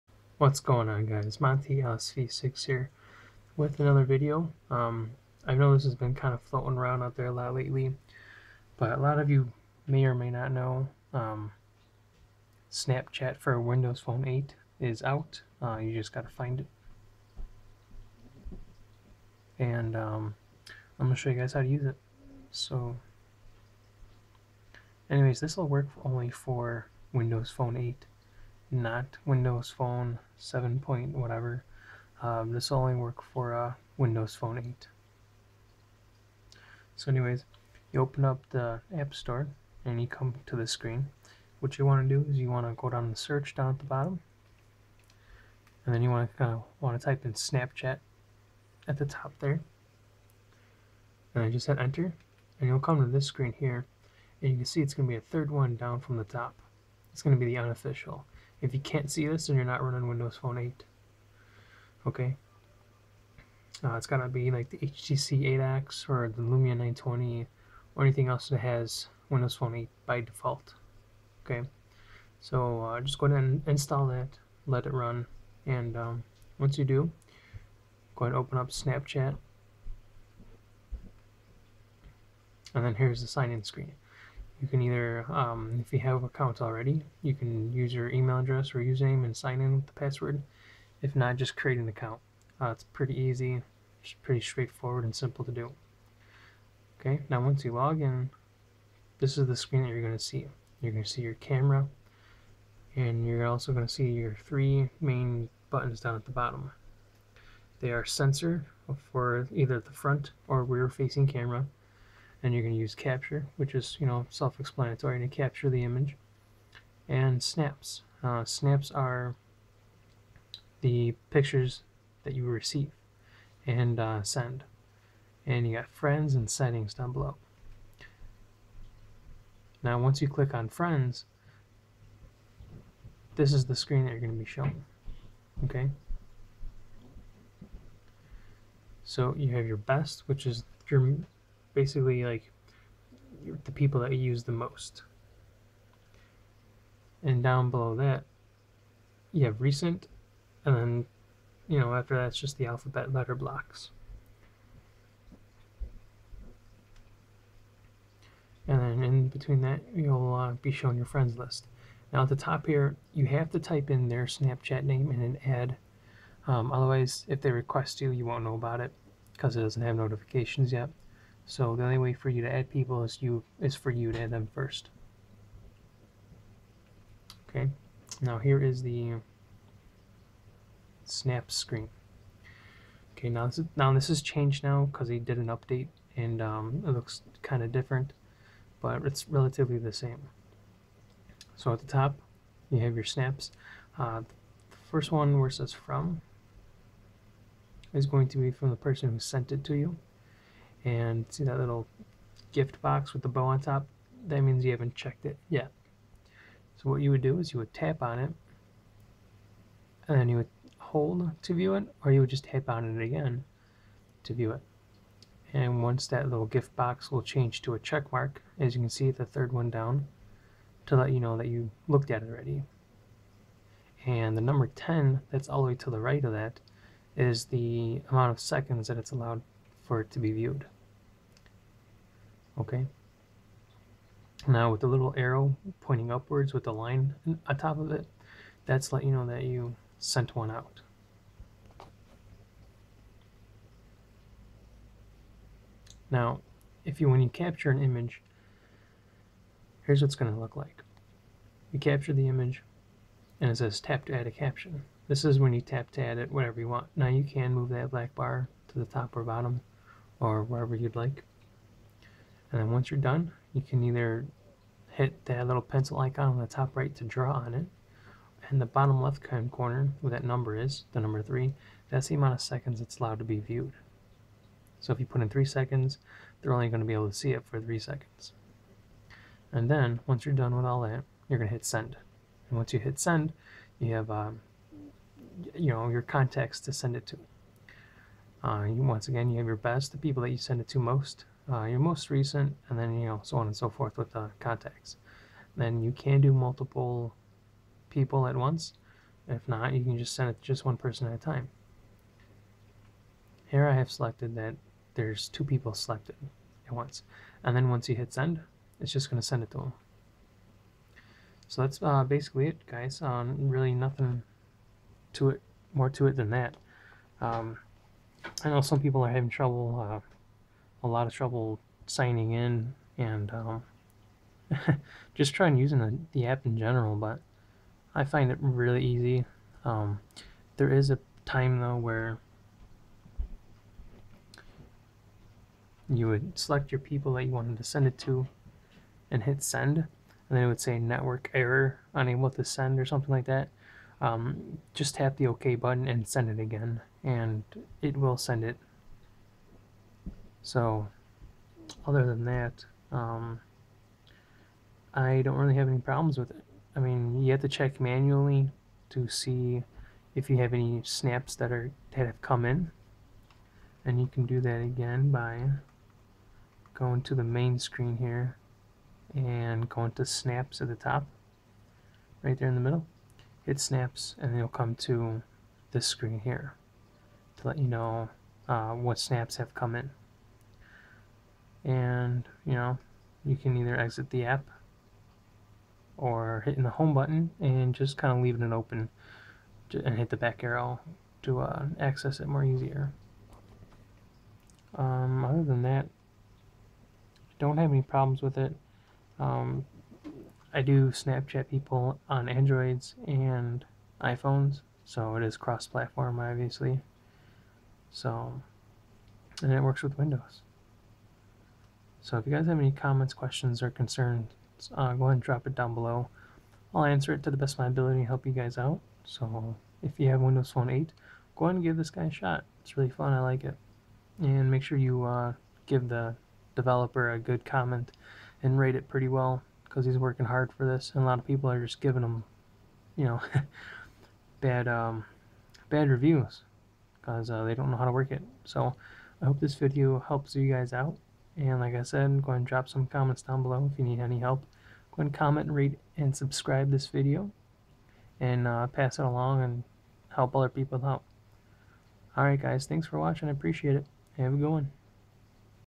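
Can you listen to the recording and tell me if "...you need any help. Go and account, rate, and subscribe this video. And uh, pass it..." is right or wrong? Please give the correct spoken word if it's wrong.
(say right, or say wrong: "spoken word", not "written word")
wrong: "comment", not "account".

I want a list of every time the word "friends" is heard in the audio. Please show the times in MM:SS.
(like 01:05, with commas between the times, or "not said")
02:05, 02:10, 02:41.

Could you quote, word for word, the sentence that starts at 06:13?
Hit snaps, and you'll come to this screen here to let you know uh, what snaps have come in.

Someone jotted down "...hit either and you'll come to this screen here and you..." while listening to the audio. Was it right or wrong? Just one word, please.
wrong.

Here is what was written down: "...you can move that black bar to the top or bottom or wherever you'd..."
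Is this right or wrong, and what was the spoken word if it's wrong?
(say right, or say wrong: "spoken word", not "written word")
right.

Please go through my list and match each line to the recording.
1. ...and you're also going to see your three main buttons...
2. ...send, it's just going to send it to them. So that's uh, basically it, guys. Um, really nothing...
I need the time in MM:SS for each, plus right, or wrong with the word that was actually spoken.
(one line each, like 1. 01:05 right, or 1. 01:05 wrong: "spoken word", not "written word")
1. 01:42 right
2. 05:08 right.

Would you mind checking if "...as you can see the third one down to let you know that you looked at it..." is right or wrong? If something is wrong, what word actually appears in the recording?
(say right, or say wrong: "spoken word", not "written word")
right.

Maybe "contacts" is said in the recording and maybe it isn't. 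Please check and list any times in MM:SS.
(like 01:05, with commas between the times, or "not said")
04:46, 04:54.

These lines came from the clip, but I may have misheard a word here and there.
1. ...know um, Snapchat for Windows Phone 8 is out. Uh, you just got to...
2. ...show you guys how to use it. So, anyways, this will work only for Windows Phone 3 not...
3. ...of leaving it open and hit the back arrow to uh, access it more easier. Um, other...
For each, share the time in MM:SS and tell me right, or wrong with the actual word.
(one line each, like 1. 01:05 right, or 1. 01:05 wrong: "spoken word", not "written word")
1. 00:10 right
2. 00:21 wrong: "8", not "3"
3. 06:28 right.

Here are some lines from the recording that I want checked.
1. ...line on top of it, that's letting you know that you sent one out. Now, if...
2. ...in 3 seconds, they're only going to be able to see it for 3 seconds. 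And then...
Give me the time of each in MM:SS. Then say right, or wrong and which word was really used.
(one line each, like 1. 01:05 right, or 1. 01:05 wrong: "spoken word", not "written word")
1. 03:56 right
2. 04:35 right.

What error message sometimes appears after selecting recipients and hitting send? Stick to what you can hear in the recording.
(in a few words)
Network error.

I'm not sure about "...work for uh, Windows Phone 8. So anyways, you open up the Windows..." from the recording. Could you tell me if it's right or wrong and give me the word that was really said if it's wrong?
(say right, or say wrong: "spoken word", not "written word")
wrong: "App", not "Windows".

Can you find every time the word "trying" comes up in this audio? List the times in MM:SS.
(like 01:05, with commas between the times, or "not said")
05:25.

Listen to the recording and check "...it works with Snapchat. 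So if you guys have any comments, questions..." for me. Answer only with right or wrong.
wrong.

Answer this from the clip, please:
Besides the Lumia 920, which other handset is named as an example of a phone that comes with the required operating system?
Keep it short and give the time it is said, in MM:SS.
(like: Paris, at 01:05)
HTC 8X, at 01:04.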